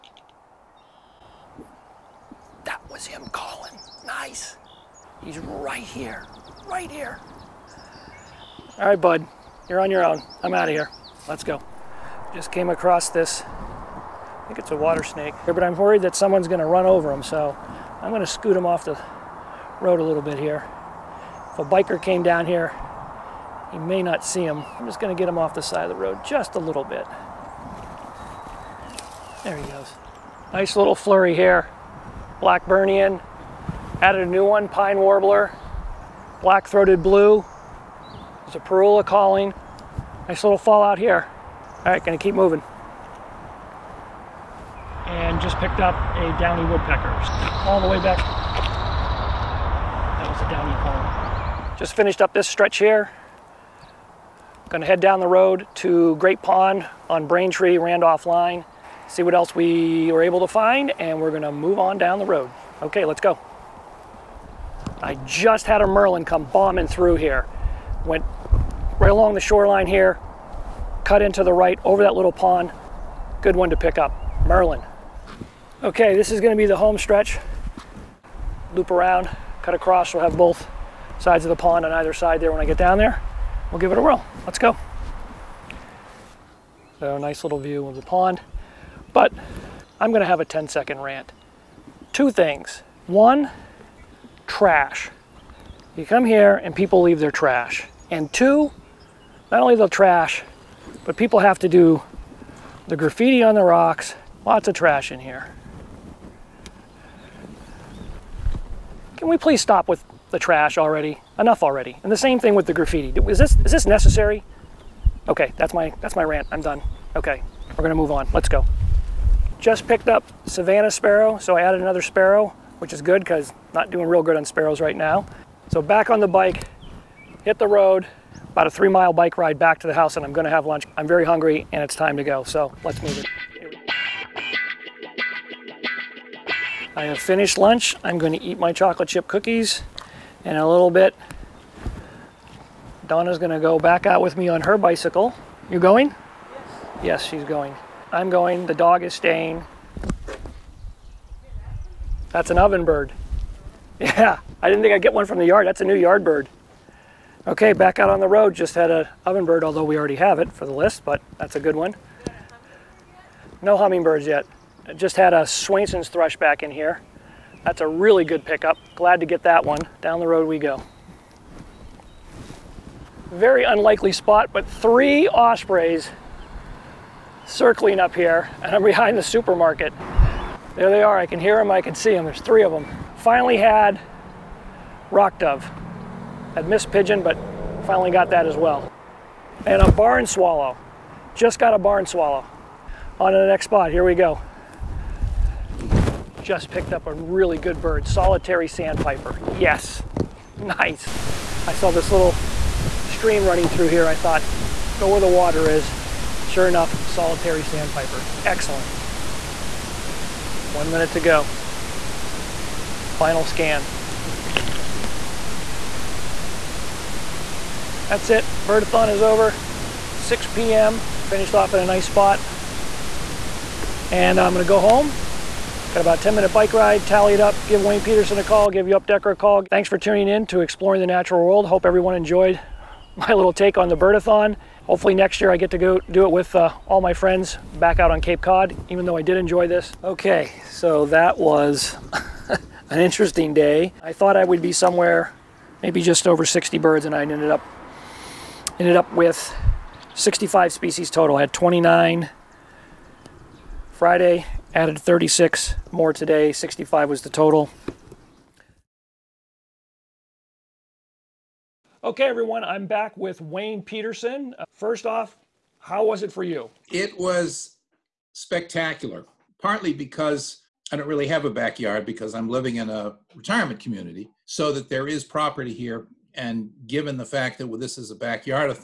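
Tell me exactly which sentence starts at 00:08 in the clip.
All right, bud, you're on your own.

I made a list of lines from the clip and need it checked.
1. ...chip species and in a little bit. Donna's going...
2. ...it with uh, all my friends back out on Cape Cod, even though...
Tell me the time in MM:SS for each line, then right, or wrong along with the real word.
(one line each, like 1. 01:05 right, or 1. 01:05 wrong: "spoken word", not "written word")
1. 02:19 wrong: "cookies", not "species"
2. 03:56 right.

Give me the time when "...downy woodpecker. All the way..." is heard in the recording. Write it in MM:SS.
00:46.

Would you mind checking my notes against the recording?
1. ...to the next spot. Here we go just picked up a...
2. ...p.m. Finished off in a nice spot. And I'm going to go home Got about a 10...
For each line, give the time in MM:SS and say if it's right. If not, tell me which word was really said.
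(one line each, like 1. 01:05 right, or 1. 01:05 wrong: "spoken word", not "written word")
1. 03:13 right
2. 03:40 right.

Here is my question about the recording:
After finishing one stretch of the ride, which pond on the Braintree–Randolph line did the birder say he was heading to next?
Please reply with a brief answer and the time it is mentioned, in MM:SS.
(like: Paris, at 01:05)
Great Pond, at 00:56.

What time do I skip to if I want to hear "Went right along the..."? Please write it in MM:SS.
01:08.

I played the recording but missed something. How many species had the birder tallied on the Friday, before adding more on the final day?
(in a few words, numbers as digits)
29.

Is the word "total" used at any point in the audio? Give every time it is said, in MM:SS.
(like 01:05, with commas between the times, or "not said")
04:11, 04:17.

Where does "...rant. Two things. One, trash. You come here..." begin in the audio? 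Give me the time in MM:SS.
01:30.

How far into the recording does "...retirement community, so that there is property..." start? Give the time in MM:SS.
04:33.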